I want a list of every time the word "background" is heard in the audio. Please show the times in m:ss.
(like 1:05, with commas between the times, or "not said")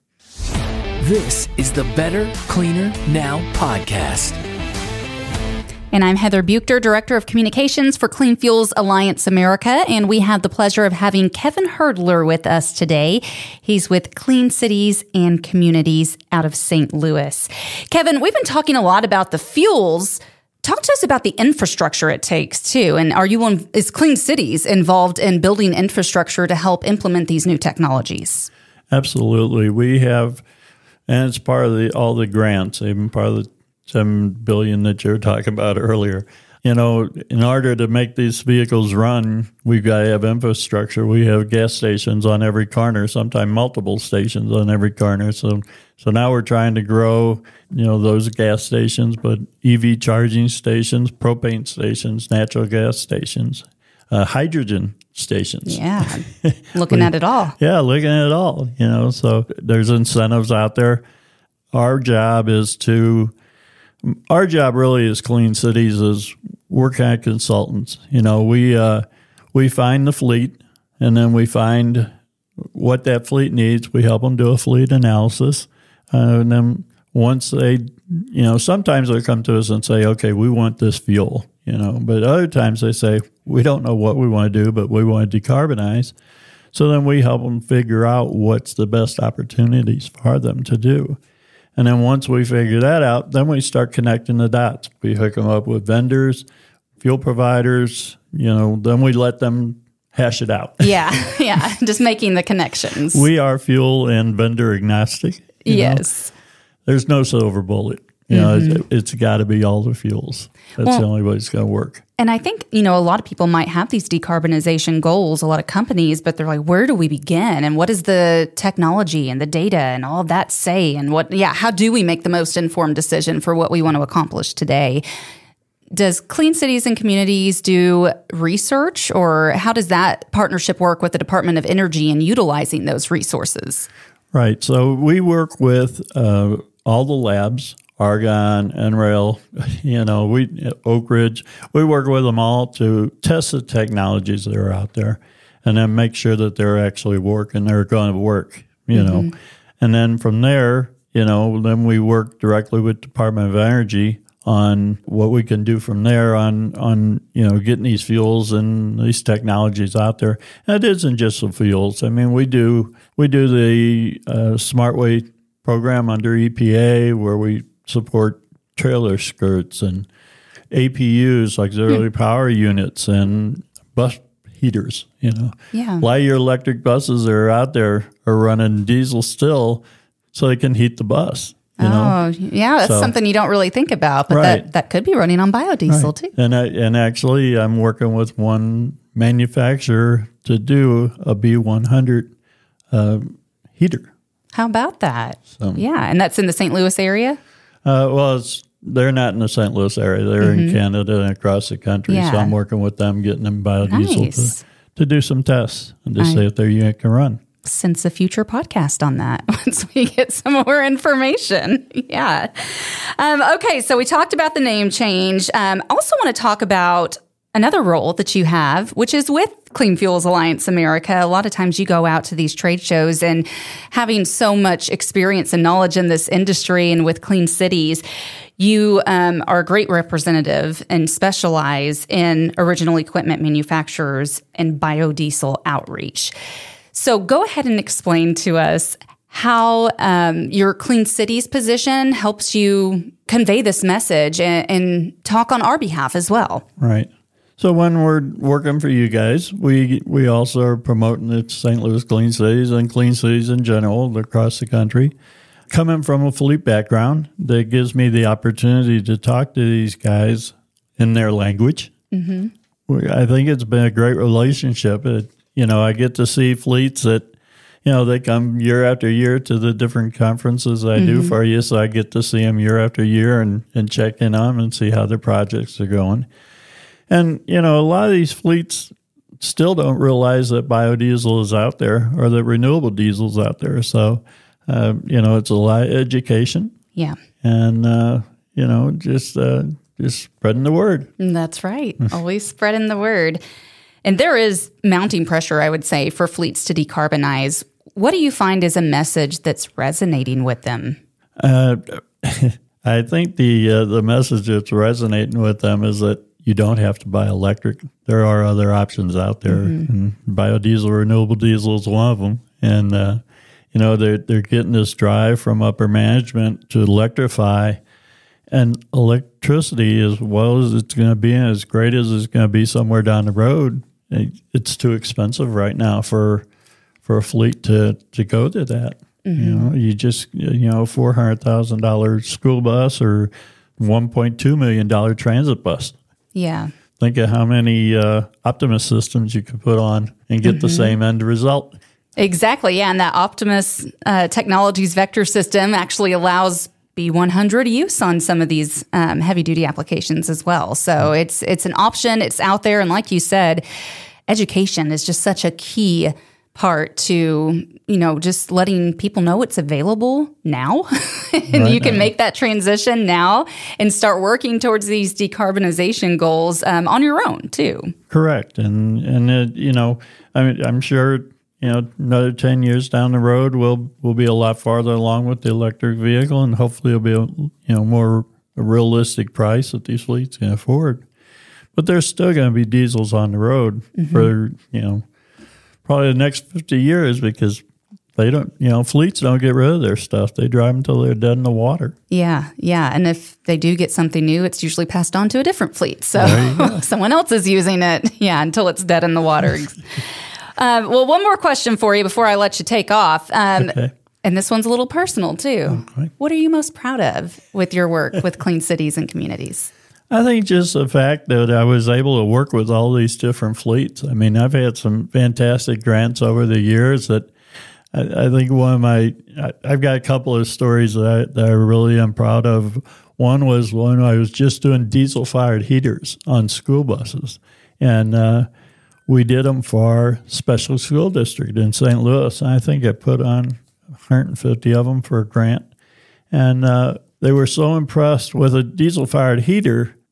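4:16.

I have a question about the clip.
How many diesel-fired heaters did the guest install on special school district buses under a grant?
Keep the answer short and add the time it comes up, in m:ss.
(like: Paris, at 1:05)
150, at 7:13.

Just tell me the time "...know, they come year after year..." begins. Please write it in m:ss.
4:27.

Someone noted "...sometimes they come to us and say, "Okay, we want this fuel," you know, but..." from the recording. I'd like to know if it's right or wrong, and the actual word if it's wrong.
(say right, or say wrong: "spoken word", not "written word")
right.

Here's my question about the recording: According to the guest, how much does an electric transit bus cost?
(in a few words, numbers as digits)
$1.2 million.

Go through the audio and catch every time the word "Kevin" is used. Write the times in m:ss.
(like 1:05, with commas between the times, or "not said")
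0:11, 0:17.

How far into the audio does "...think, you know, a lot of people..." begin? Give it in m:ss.
1:52.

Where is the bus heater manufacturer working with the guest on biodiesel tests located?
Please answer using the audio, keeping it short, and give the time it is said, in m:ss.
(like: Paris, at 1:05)
Canada, at 3:20.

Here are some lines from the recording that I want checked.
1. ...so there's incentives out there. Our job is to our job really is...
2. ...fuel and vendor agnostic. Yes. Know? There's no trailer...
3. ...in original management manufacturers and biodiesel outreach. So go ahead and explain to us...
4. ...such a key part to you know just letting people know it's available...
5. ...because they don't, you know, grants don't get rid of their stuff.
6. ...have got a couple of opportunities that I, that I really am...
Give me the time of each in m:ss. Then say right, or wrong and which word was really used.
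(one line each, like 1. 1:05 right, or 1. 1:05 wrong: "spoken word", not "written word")
1. 0:59 right
2. 1:43 wrong: "silver", not "trailer"
3. 3:52 wrong: "equipment", not "management"
4. 5:55 right
5. 6:27 wrong: "fleets", not "grants"
6. 6:59 wrong: "stories", not "opportunities".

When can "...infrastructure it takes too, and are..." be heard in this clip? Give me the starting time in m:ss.
0:21.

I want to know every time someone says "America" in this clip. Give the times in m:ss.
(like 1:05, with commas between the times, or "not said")
0:09, 3:40.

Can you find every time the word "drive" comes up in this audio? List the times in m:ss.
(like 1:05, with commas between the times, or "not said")
5:14, 6:30.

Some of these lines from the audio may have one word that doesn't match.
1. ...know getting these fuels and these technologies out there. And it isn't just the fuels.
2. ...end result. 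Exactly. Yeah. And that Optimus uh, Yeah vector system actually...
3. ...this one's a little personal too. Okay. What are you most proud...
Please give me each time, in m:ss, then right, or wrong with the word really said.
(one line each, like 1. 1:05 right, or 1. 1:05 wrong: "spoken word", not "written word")
1. 2:37 right
2. 5:41 wrong: "Technologies", not "Yeah"
3. 6:44 right.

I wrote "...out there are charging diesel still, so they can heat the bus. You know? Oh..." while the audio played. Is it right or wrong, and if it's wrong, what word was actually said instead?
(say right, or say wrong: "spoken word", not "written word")
wrong: "running", not "charging".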